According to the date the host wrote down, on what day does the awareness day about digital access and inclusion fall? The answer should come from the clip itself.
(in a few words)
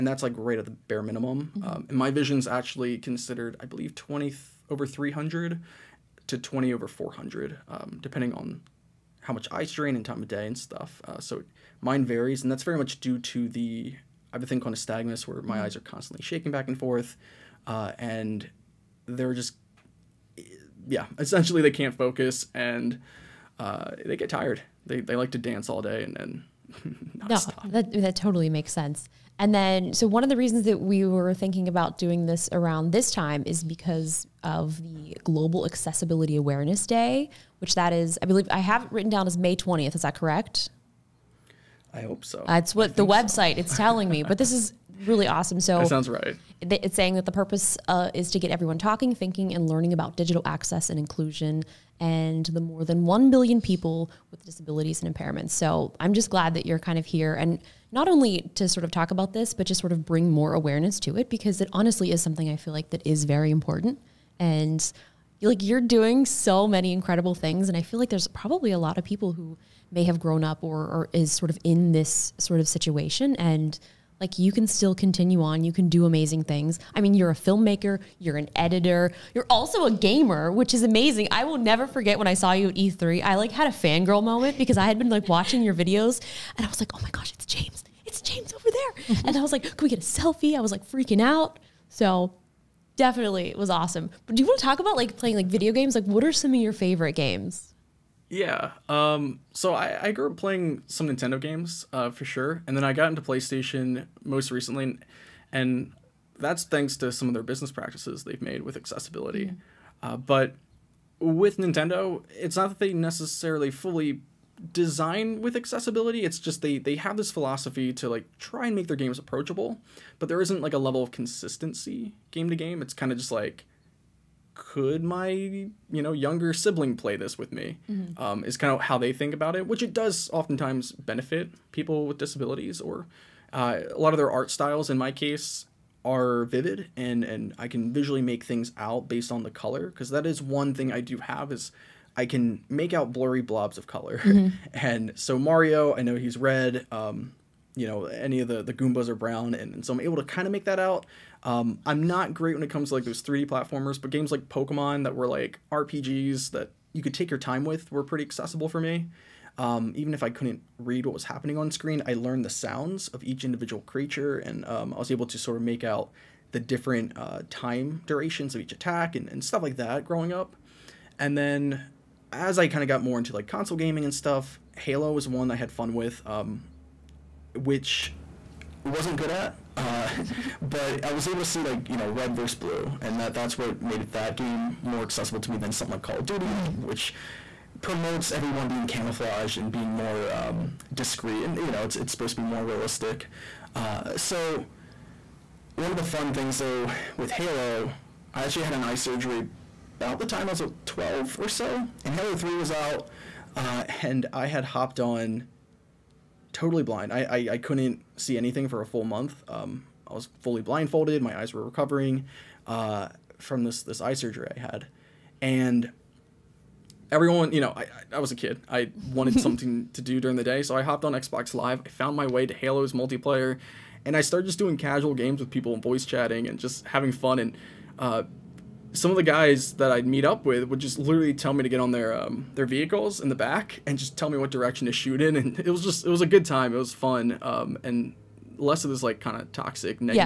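May 20th.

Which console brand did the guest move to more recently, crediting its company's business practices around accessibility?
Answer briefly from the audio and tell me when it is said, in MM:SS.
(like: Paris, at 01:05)
PlayStation, at 01:43.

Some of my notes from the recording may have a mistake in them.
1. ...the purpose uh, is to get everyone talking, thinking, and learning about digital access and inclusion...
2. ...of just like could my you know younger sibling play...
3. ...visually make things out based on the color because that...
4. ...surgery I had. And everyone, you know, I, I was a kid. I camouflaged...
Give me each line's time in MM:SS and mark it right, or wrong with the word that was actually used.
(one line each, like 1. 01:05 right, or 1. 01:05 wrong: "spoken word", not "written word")
1. 00:47 right
2. 02:03 right
3. 02:17 right
4. 03:34 wrong: "wanted", not "camouflaged".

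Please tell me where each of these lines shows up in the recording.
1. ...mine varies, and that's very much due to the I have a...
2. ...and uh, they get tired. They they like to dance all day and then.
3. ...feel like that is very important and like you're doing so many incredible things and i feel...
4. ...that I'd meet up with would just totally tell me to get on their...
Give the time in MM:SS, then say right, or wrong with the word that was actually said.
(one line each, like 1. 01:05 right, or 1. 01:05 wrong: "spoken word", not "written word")
1. 00:11 right
2. 00:22 right
3. 01:02 right
4. 03:49 wrong: "literally", not "totally".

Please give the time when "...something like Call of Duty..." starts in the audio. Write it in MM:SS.
03:05.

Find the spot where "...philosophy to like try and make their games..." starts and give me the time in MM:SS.
01:57.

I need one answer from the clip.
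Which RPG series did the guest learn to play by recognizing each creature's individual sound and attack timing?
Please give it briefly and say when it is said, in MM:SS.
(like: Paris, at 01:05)
Pokemon, at 02:34.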